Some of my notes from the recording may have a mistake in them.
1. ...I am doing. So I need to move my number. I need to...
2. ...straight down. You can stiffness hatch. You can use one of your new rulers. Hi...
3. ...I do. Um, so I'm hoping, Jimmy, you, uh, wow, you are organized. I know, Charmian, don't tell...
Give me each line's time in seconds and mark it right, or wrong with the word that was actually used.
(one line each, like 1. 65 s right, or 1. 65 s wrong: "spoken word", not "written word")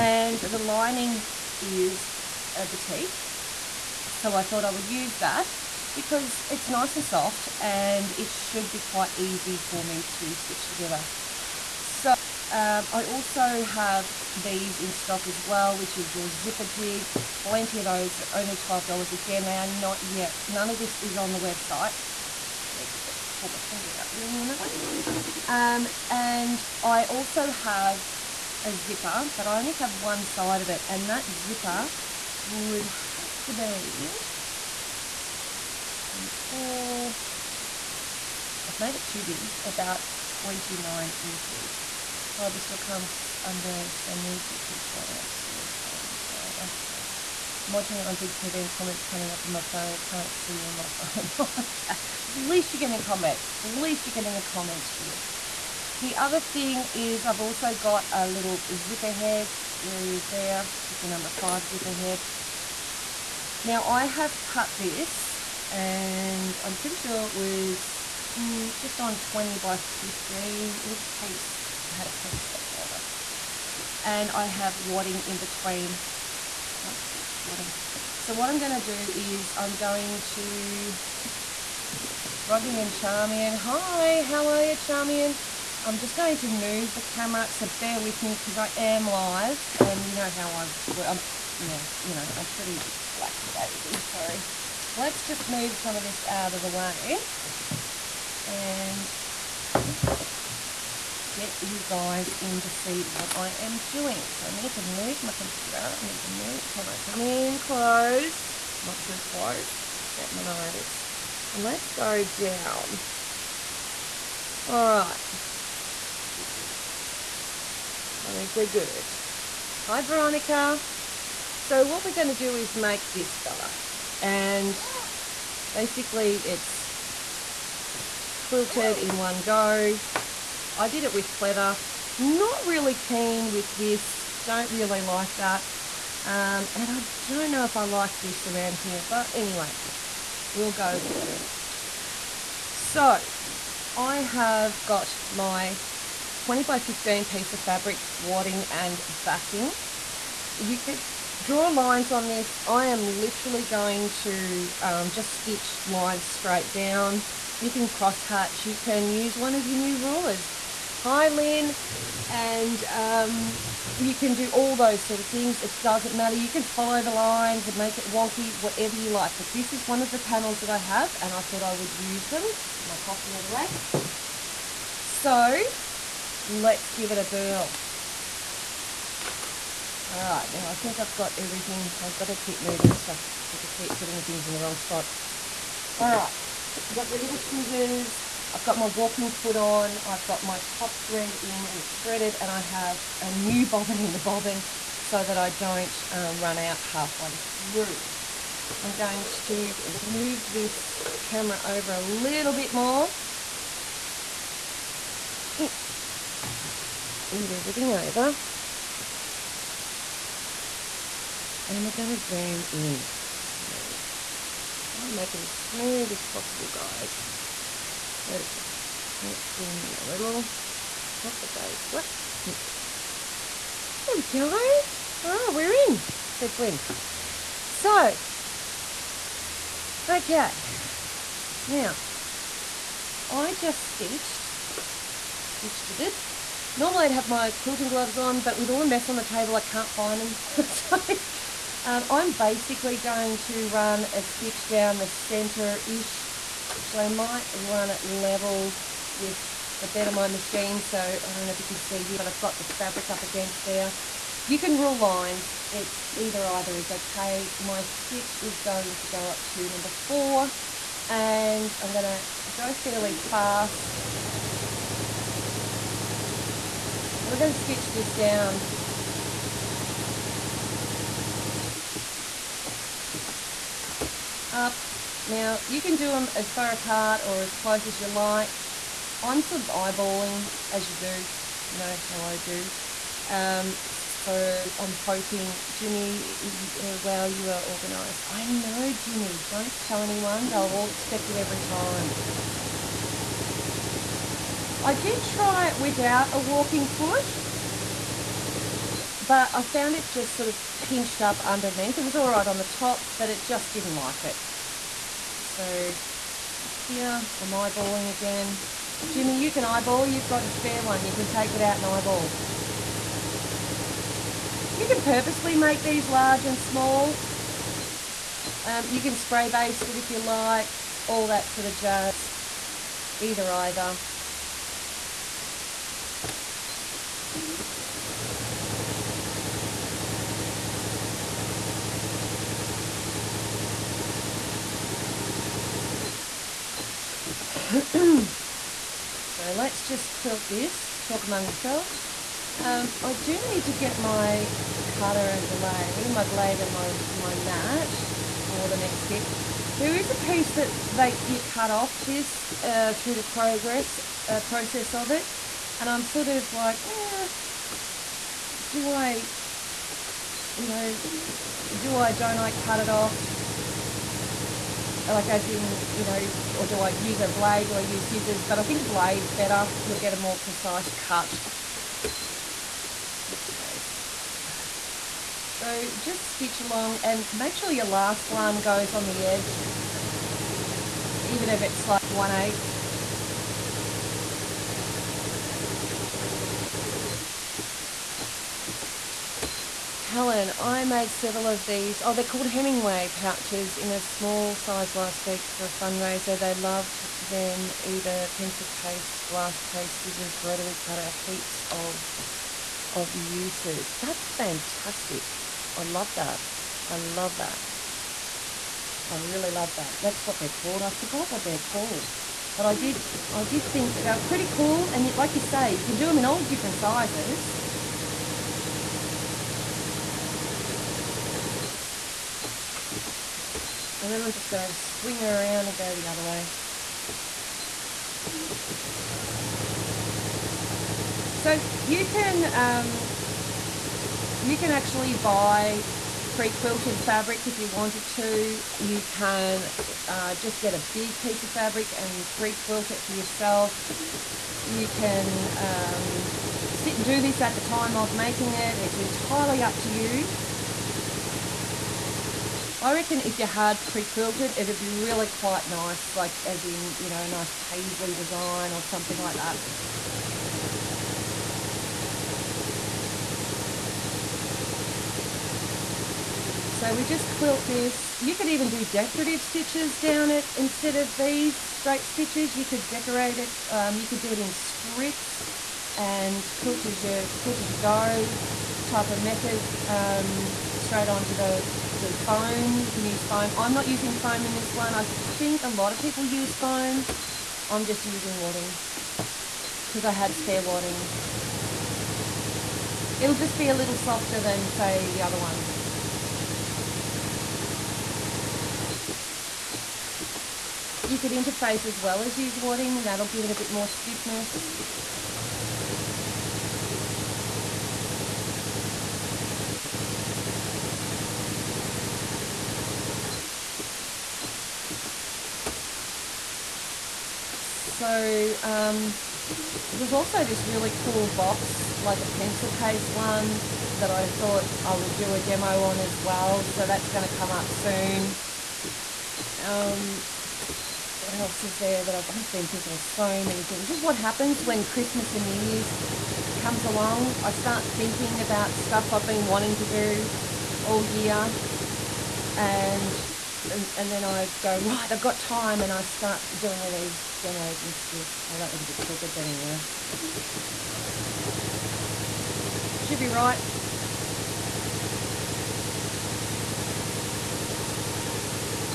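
1. 103 s wrong: "computer", not "number"
2. 156 s wrong: "cross", not "stiffness"
3. 282 s wrong: "Jimmy", not "Charmian".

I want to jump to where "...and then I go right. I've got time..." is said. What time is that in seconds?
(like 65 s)
543 s.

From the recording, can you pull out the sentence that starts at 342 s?
Um, I do need to get my cutter and blade, my blade and my, my mat for the next bit.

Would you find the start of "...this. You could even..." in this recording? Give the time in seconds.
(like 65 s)
467 s.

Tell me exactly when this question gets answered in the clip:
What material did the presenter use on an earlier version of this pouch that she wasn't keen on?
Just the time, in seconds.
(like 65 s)
131 s.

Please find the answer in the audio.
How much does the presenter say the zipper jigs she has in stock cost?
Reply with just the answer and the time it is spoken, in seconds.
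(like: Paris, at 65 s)
$12, at 18 s.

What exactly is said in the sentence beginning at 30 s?
And that zipper would have to be 24.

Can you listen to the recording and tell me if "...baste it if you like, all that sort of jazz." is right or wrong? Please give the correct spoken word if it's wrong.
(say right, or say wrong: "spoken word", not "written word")
right.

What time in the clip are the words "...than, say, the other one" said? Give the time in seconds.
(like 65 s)
494 s.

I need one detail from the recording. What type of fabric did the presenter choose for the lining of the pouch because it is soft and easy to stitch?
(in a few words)
batik.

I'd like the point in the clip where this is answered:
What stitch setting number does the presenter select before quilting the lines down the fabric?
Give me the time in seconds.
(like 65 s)
259 s.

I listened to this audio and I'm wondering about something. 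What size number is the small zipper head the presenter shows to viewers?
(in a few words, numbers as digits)
5.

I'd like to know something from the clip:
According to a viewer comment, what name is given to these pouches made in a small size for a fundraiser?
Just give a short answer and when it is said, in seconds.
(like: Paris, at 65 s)
Hemingway pouches, at 392 s.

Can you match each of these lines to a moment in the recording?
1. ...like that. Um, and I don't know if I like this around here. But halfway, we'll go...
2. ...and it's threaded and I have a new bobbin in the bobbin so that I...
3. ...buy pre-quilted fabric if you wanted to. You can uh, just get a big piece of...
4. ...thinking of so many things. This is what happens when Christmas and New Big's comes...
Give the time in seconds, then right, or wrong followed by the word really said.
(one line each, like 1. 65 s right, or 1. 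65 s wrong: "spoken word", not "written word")
1. 135 s wrong: "anyway", not "halfway"
2. 191 s right
3. 435 s right
4. 532 s wrong: "Year", not "Big".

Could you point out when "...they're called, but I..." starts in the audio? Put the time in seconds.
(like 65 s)
411 s.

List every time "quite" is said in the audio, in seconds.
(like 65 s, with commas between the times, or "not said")
8 s, 455 s.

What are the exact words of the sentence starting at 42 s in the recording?
Triber still comes under, so need to keep scrolling up to see your phone as well.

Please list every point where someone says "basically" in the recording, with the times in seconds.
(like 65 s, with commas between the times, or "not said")
125 s, 242 s.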